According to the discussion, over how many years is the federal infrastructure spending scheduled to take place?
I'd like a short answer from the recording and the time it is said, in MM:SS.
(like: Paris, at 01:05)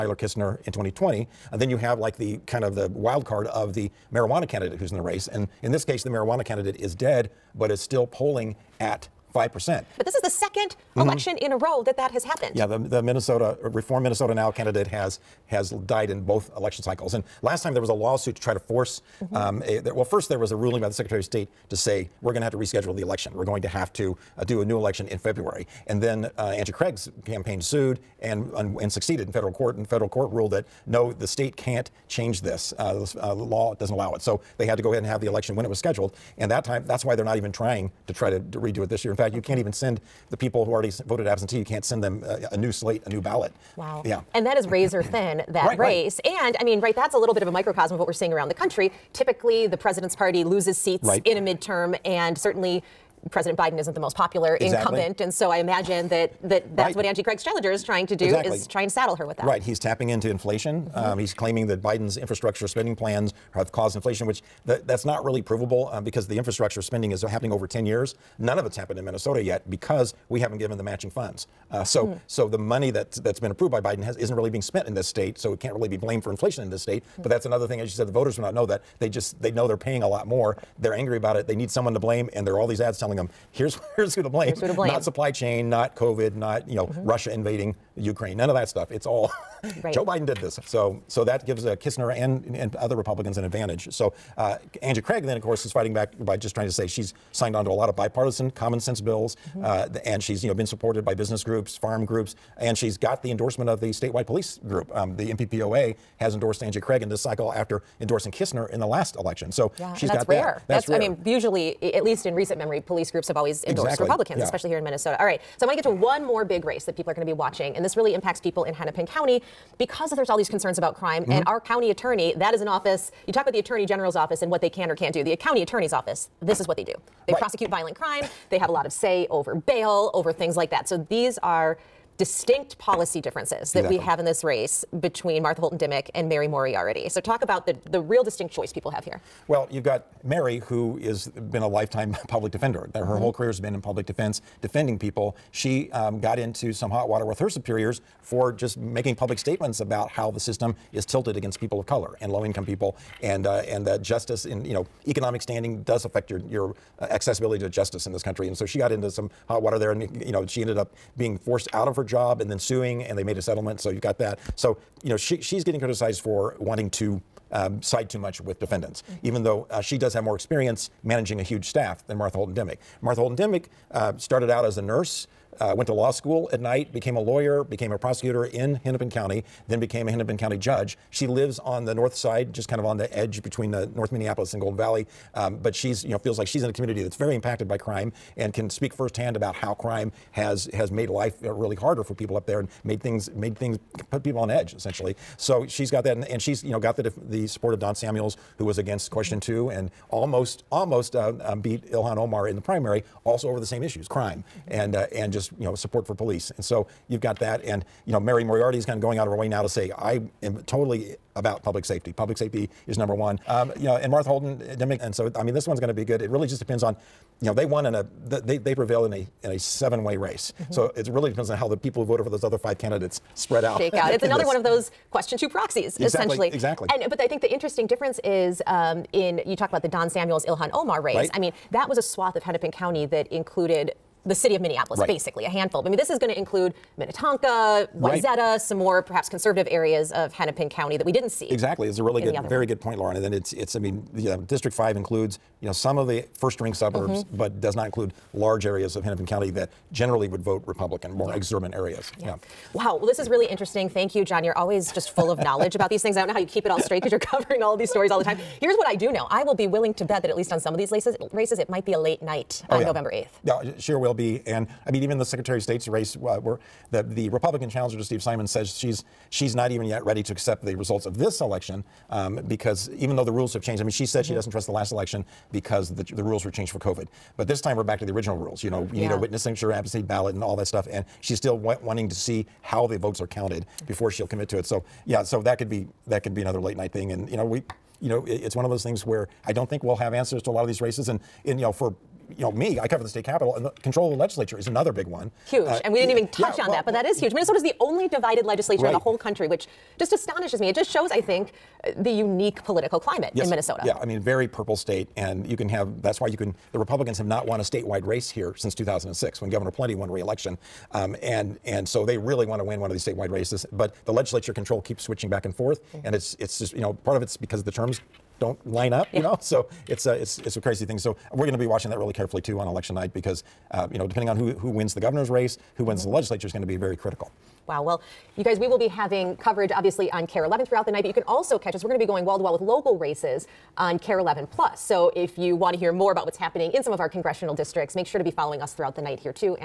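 10 years, at 01:07.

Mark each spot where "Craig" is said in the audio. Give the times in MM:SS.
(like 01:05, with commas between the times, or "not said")
00:26, 00:57, 01:34, 01:46.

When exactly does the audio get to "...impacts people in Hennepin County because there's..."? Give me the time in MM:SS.
01:58.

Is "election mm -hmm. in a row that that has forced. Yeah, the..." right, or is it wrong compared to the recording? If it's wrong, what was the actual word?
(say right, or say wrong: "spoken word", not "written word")
wrong: "happened", not "forced".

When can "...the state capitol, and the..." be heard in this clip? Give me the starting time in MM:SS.
04:53.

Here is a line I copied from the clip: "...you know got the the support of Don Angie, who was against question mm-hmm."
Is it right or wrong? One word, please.
wrong.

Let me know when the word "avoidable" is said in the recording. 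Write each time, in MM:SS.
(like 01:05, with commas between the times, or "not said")
not said.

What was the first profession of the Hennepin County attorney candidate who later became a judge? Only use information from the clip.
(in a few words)
Nurse.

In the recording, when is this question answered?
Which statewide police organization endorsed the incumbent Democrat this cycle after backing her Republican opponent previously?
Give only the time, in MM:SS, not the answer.
01:45.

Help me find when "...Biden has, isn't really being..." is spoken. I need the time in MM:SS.
01:13.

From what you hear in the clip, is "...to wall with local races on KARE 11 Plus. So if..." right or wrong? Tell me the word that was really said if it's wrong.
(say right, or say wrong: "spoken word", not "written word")
right.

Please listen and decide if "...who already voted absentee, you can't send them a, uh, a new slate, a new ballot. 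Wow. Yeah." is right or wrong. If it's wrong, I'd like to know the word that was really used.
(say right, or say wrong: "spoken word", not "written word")
right.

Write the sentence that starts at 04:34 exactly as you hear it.
she doesn't trust the last election because the, the, rules were changed for COVID.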